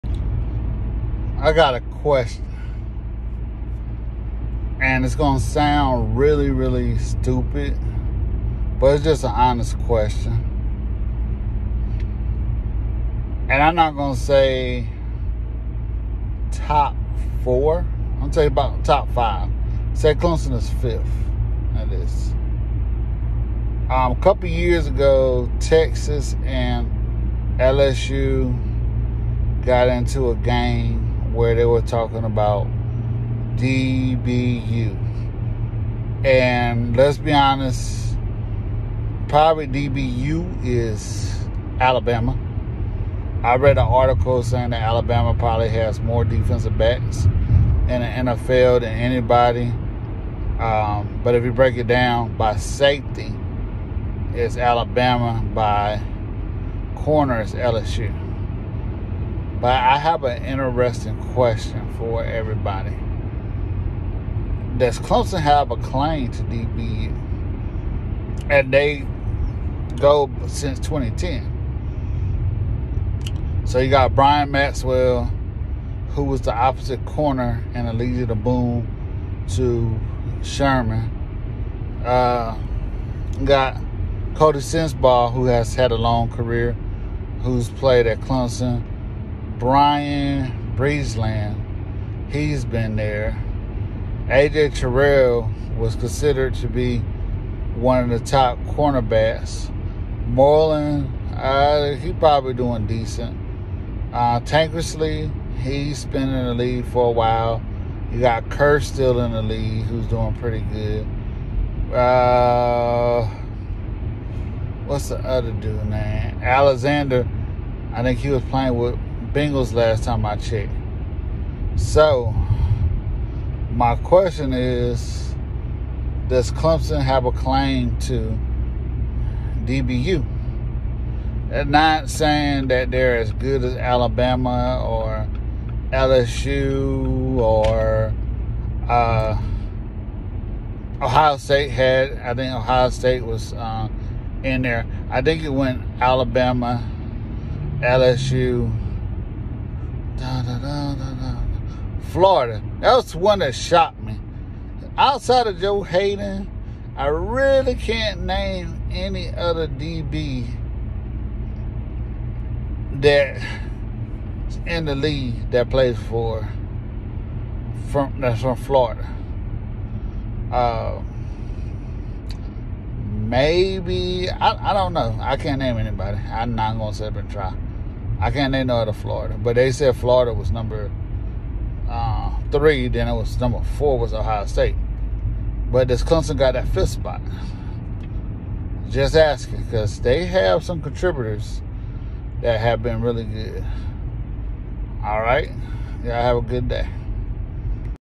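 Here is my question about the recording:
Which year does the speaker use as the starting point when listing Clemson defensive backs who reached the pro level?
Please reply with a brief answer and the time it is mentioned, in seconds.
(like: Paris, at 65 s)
2010, at 70 s.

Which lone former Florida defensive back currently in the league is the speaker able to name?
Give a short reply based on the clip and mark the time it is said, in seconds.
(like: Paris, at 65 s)
Joe Haden, at 155 s.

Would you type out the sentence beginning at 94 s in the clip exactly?
AJ Terrell was considered to be one of the top cornerbacks.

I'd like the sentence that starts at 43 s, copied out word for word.
I read an article saying that Alabama probably has more defensive backs in the NFL than anybody.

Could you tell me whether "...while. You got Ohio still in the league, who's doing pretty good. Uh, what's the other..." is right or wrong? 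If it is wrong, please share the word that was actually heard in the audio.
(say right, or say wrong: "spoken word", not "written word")
wrong: "Kerr", not "Ohio".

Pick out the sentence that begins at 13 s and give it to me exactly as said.
And I'm not going to say top four.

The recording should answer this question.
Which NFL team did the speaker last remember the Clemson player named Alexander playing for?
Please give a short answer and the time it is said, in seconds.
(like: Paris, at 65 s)
Bengals, at 119 s.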